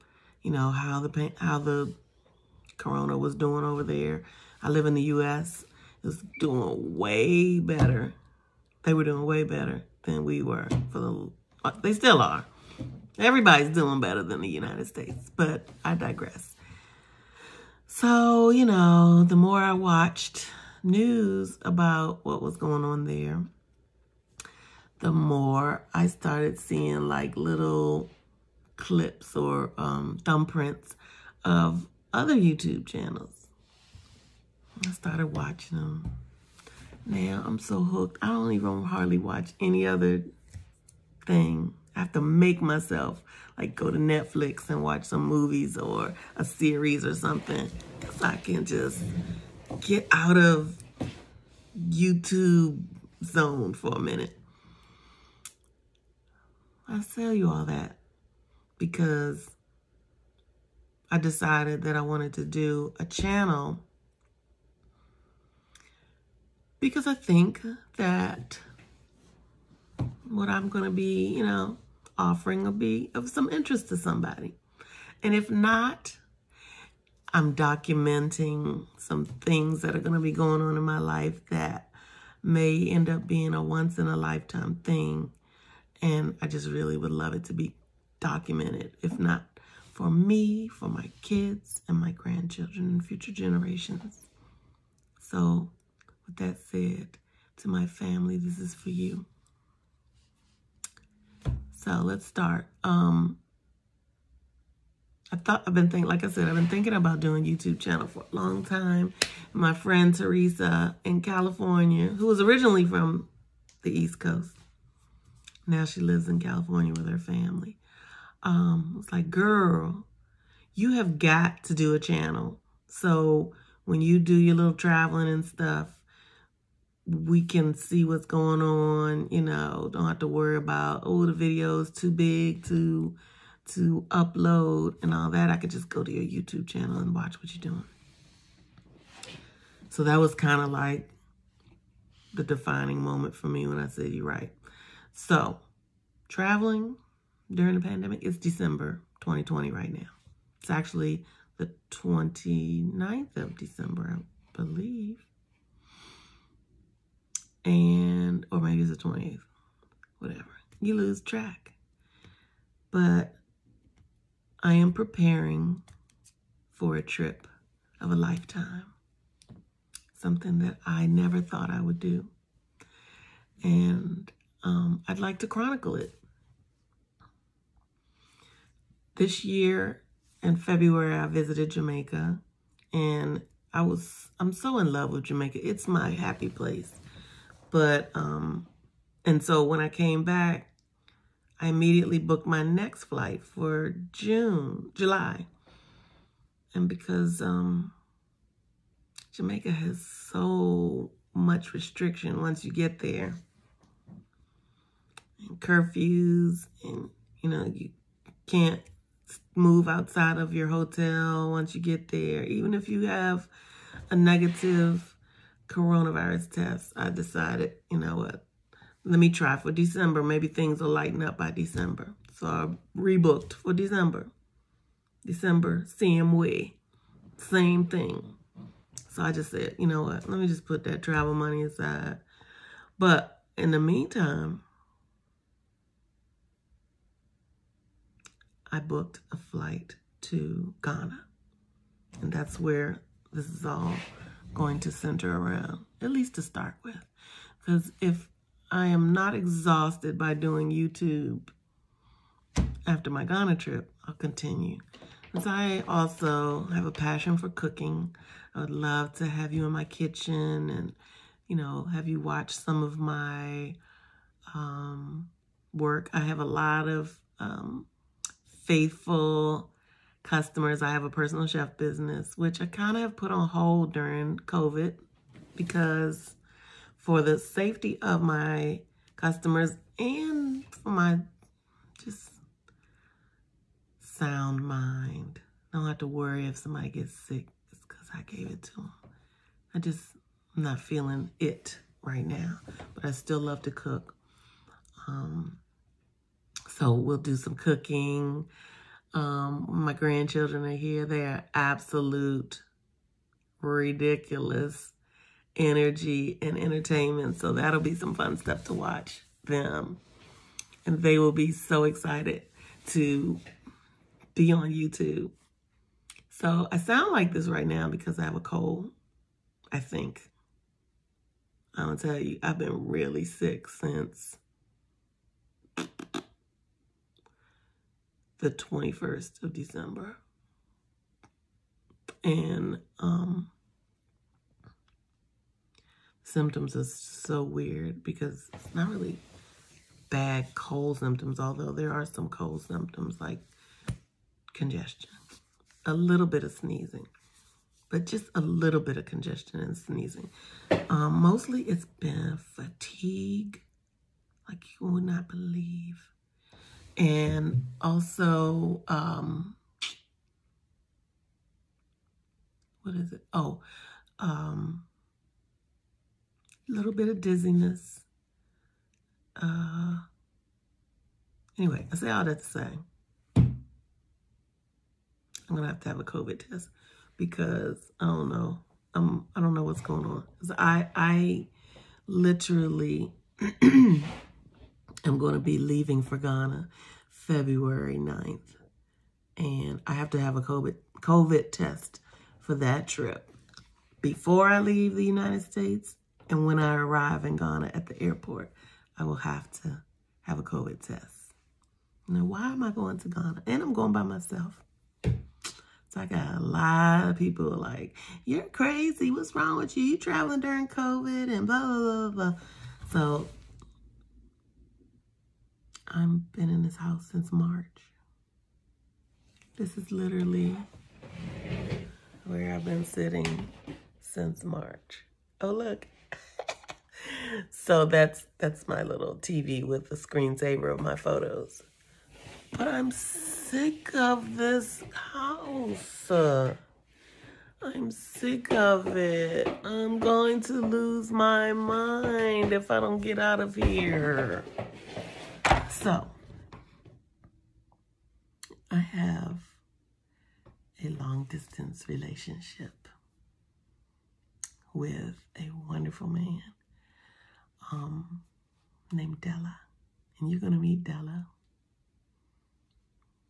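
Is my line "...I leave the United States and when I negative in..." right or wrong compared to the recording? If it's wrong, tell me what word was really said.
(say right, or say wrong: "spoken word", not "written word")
wrong: "arrive", not "negative".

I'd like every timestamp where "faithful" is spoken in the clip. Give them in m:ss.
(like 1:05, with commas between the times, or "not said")
4:28.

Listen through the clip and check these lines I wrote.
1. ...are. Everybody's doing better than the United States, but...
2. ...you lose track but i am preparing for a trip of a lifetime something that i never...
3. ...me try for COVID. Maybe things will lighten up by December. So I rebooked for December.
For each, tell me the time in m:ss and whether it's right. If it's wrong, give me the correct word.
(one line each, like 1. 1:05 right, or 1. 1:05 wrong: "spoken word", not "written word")
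1. 0:12 right
2. 2:40 right
3. 3:39 wrong: "December", not "COVID".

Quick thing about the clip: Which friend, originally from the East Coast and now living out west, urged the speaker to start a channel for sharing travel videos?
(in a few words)
Teresa.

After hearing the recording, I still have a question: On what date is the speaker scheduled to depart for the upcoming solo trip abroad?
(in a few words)
February 9th.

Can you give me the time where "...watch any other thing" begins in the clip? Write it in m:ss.
0:39.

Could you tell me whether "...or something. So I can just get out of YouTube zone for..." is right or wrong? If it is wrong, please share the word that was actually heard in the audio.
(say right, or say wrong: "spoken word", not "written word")
right.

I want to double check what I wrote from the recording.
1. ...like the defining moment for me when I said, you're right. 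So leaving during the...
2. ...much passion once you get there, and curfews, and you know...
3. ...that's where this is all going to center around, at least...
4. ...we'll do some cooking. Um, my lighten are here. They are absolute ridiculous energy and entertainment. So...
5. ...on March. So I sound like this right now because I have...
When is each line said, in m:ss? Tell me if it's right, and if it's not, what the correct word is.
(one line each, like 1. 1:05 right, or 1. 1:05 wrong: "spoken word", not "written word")
1. 2:20 wrong: "traveling", not "leaving"
2. 3:21 wrong: "restriction", not "passion"
3. 4:02 right
4. 4:56 wrong: "grandchildren", not "lighten"
5. 5:14 wrong: "YouTube", not "March".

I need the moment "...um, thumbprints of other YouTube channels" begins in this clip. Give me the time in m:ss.
0:29.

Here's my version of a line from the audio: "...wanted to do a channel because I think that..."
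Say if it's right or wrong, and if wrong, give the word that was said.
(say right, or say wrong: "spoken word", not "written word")
right.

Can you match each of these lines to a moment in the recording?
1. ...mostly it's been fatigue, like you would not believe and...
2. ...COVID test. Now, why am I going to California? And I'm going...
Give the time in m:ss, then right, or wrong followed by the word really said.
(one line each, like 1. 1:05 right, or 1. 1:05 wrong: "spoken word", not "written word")
1. 5:51 right
2. 6:40 wrong: "Ghana", not "California".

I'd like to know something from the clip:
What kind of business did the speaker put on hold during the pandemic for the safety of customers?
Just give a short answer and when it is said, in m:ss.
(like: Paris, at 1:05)
personal chef business, at 4:31.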